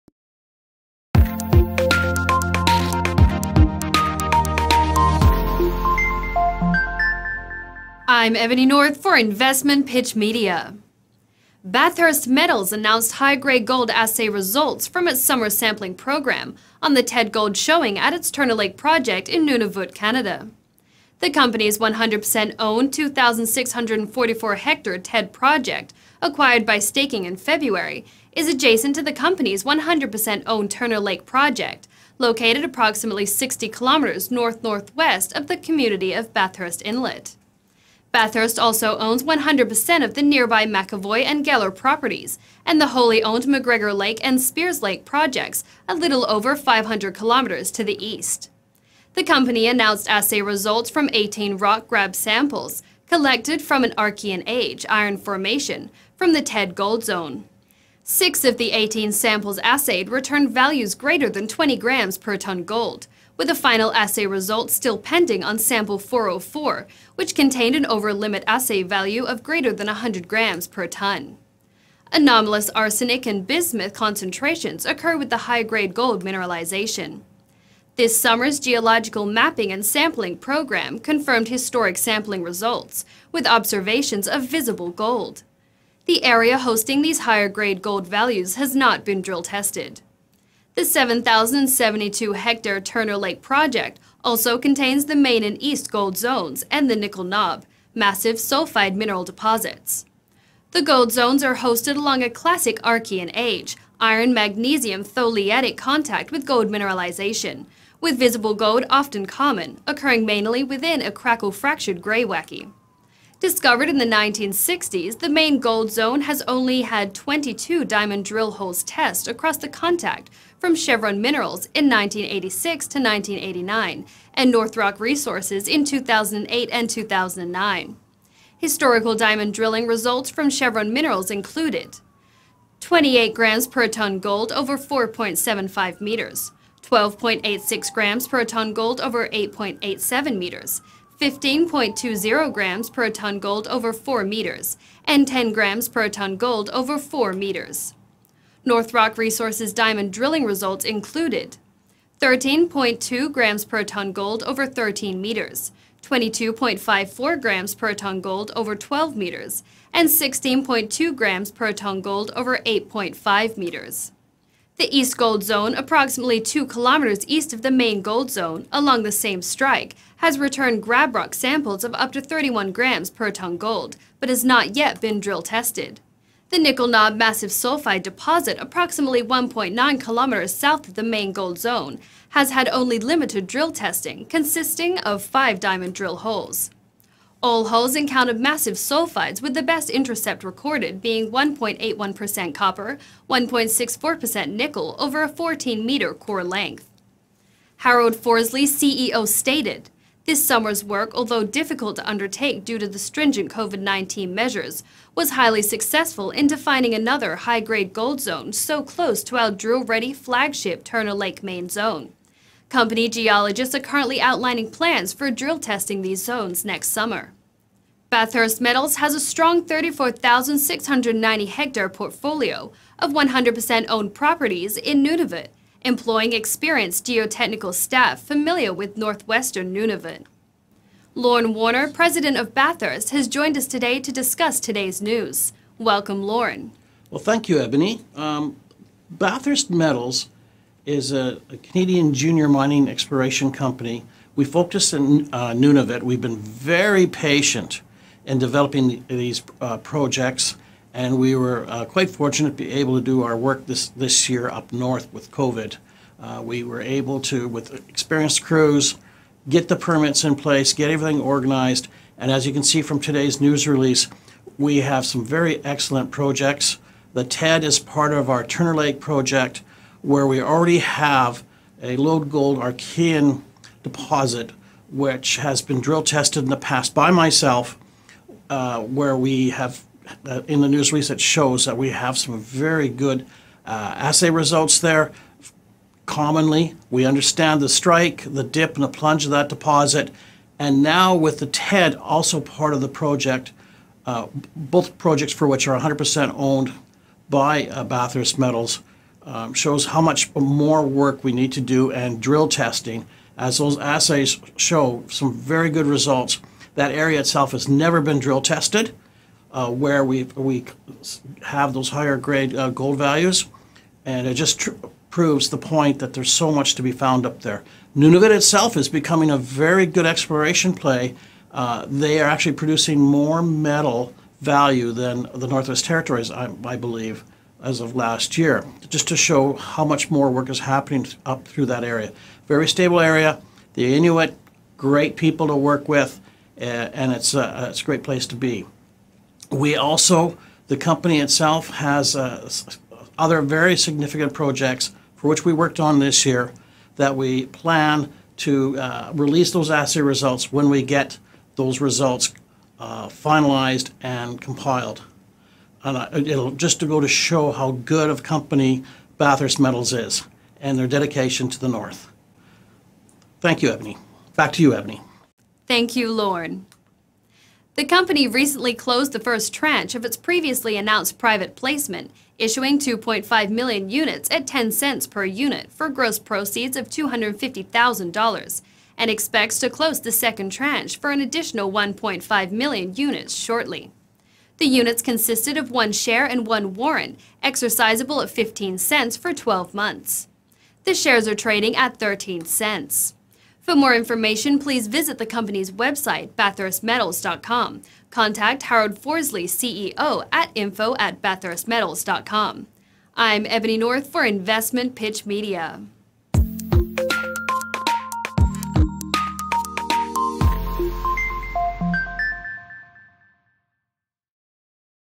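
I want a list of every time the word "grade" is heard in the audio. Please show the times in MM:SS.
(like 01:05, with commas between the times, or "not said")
00:13, 01:15, 01:27, 03:27, 05:12.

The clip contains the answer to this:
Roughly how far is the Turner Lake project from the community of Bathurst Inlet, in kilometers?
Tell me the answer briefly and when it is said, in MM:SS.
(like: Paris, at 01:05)
60 kilometers, at 00:33.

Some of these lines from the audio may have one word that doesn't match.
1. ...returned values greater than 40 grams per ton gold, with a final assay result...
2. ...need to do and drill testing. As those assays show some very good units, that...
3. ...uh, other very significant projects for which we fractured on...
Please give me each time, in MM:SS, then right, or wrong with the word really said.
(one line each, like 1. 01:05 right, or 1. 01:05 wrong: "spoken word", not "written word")
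1. 01:00 wrong: "20", not "40"
2. 05:01 wrong: "results", not "units"
3. 05:42 wrong: "worked", not "fractured".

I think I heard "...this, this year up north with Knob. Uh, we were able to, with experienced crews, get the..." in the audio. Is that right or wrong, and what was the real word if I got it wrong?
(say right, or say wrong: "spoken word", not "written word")
wrong: "COVID", not "Knob".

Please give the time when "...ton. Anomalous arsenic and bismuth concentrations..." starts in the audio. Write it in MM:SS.
01:10.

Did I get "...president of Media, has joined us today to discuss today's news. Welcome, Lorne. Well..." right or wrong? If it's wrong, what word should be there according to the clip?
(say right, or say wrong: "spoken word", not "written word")
wrong: "Bathurst", not "Media".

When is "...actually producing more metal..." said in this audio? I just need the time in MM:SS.
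05:22.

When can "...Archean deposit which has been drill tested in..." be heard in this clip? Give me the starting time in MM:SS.
04:32.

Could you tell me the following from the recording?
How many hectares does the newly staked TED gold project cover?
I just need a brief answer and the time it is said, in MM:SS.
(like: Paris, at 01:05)
2,644, at 00:22.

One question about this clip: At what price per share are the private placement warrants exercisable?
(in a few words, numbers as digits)
15 cents.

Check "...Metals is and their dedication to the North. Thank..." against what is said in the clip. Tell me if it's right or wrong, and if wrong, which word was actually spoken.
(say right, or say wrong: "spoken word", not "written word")
right.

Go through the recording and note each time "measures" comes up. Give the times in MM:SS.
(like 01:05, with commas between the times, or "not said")
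03:24.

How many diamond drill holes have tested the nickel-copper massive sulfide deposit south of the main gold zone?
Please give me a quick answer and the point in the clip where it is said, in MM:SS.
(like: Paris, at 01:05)
5, at 03:05.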